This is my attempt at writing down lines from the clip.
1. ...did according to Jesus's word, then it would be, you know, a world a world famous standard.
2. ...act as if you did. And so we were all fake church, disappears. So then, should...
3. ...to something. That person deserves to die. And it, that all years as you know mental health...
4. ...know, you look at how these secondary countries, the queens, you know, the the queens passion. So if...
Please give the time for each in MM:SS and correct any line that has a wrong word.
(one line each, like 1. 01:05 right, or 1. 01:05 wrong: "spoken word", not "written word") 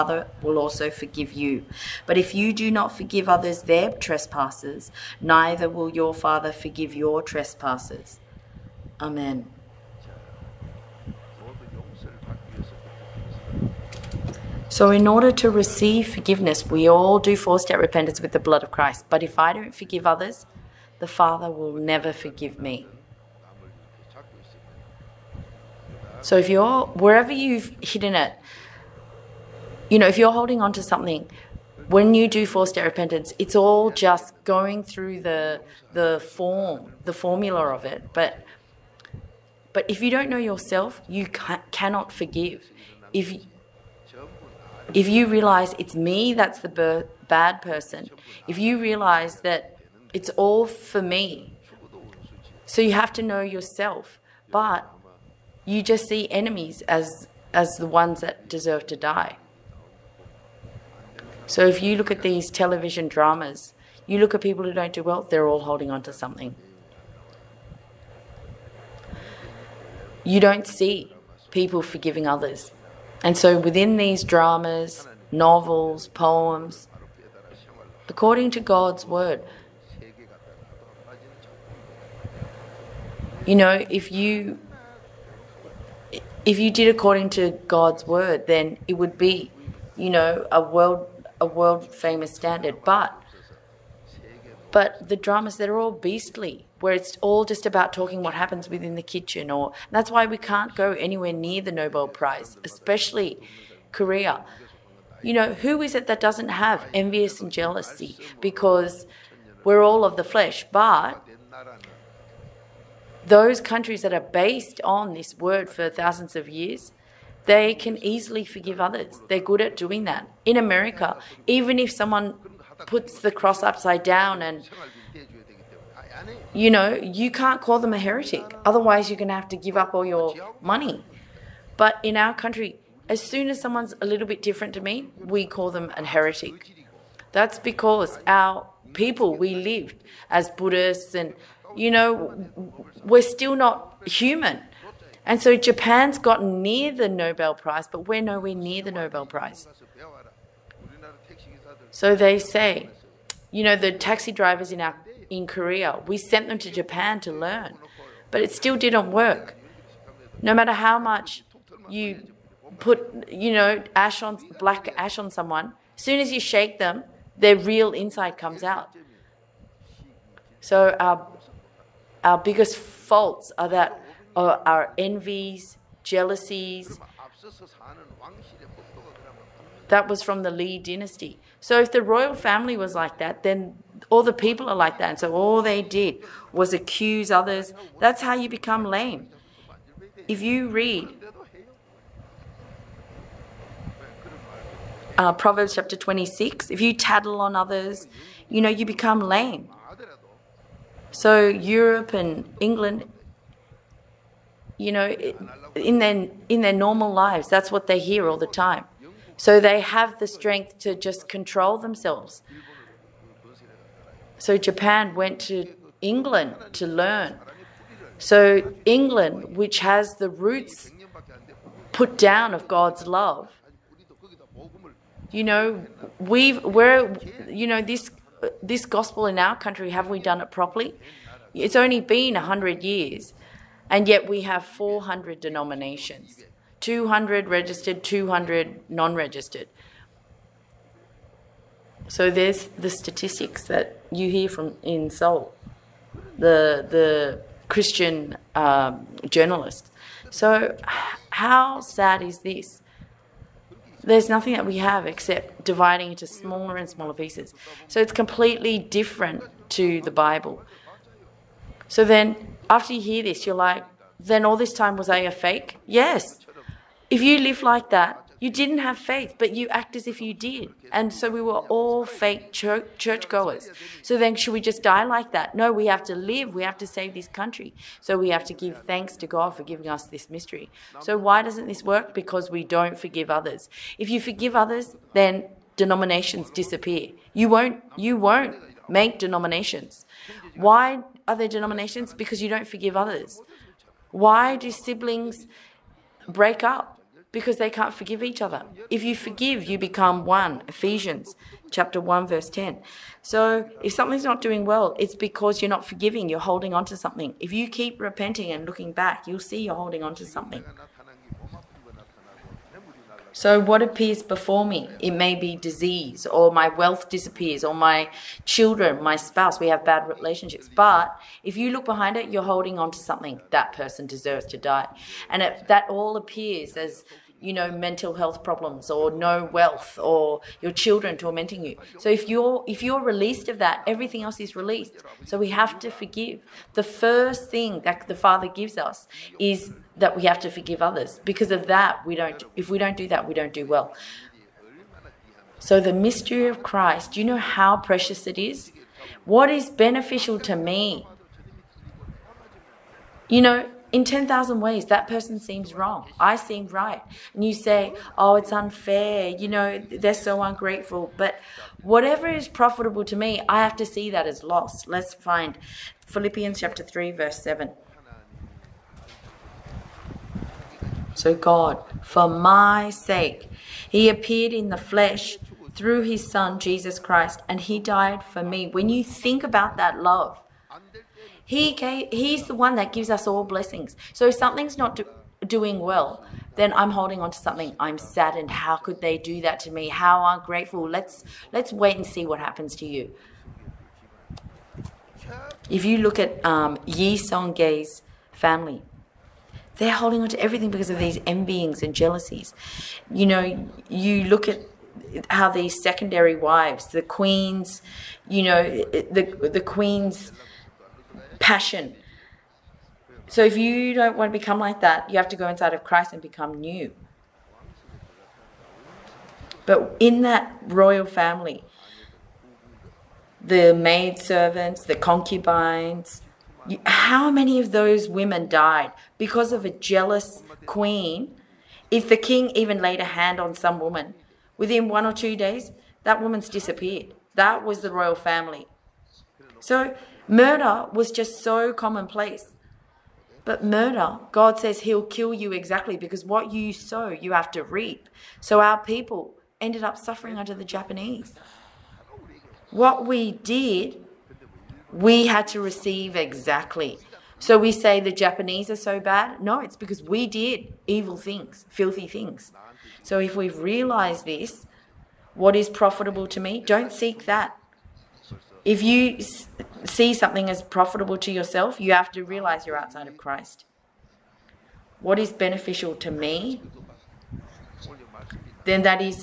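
1. 01:26 wrong: "God", not "Jesus"
2. 04:29 wrong: "churchgoers", not "disappears"
3. 05:22 wrong: "appears", not "years"
4. 06:43 wrong: "wives", not "countries".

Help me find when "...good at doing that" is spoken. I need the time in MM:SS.
01:59.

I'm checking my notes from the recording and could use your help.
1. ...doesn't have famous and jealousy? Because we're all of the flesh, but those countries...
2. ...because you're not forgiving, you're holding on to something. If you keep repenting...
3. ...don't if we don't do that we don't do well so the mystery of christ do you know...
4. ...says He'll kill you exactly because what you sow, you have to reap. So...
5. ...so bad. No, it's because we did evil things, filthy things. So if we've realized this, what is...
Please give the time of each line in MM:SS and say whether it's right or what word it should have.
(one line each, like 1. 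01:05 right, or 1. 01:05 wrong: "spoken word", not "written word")
1. 01:46 wrong: "envious", not "famous"
2. 05:05 right
3. 05:42 right
4. 07:24 right
5. 07:38 right.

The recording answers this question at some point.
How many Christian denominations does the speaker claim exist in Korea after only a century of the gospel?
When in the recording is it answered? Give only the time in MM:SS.
03:54.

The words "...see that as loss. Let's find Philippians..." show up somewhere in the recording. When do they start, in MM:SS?
06:03.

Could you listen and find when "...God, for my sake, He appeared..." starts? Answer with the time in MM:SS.
06:11.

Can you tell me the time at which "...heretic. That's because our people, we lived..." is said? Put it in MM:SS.
02:16.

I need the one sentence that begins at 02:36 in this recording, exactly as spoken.
We sent them to Japan to learn, but it still didn't work.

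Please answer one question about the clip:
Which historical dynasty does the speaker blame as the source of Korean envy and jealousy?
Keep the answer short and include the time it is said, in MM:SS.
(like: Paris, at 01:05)
Lee dynasty, at 03:00.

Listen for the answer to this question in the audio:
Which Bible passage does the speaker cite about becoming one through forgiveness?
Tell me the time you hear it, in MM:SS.
05:00.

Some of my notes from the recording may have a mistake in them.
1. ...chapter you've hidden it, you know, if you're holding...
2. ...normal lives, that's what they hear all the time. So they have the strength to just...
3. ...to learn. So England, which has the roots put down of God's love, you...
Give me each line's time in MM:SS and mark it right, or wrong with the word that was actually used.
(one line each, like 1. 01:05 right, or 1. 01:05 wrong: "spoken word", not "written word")
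1. 00:27 wrong: "wherever", not "chapter"
2. 03:26 right
3. 03:36 right.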